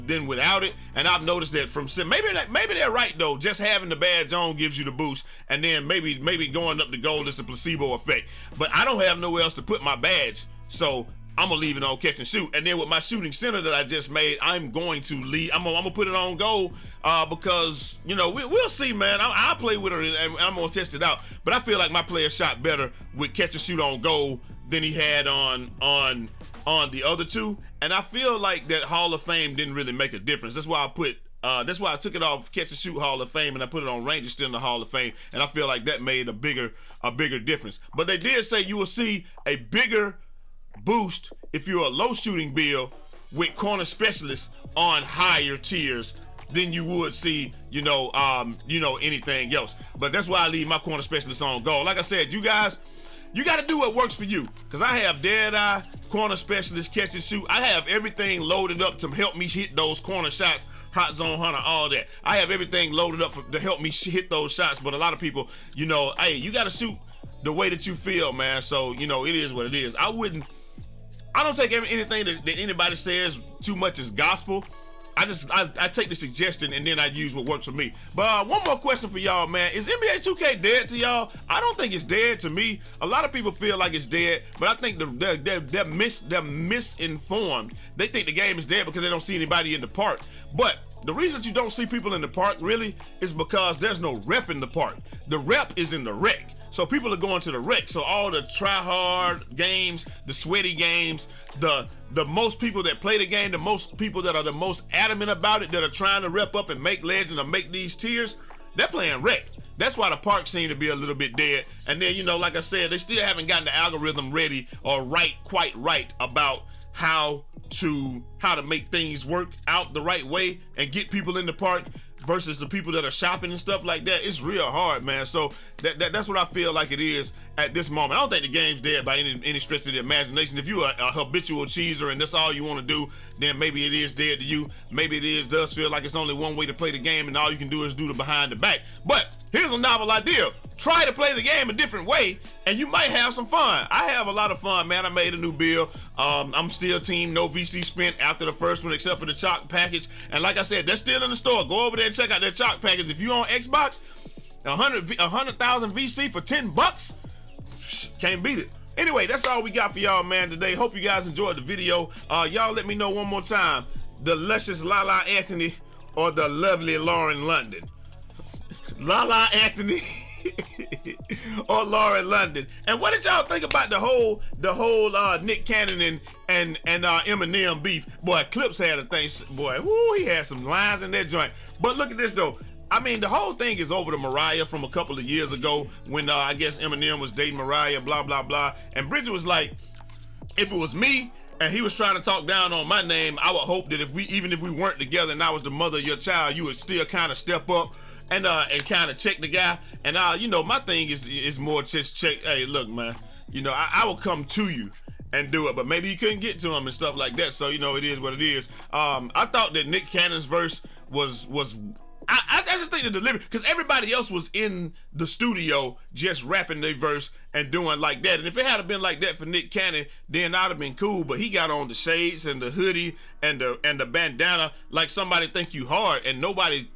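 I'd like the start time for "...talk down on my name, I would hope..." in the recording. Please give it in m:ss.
3:12.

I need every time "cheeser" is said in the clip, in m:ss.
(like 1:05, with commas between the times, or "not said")
2:11.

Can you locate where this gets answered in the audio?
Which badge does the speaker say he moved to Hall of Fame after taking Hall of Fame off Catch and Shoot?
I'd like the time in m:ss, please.
0:34.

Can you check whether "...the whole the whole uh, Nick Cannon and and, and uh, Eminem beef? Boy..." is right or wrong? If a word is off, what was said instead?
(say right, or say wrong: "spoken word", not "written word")
right.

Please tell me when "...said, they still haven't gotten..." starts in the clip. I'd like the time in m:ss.
1:52.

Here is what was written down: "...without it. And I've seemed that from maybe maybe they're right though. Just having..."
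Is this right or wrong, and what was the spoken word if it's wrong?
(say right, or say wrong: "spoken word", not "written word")
wrong: "noticed", not "seemed".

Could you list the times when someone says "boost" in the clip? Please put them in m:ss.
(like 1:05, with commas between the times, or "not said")
0:04, 0:40.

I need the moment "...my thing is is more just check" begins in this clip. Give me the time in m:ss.
3:20.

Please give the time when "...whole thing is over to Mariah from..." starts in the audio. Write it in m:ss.
3:03.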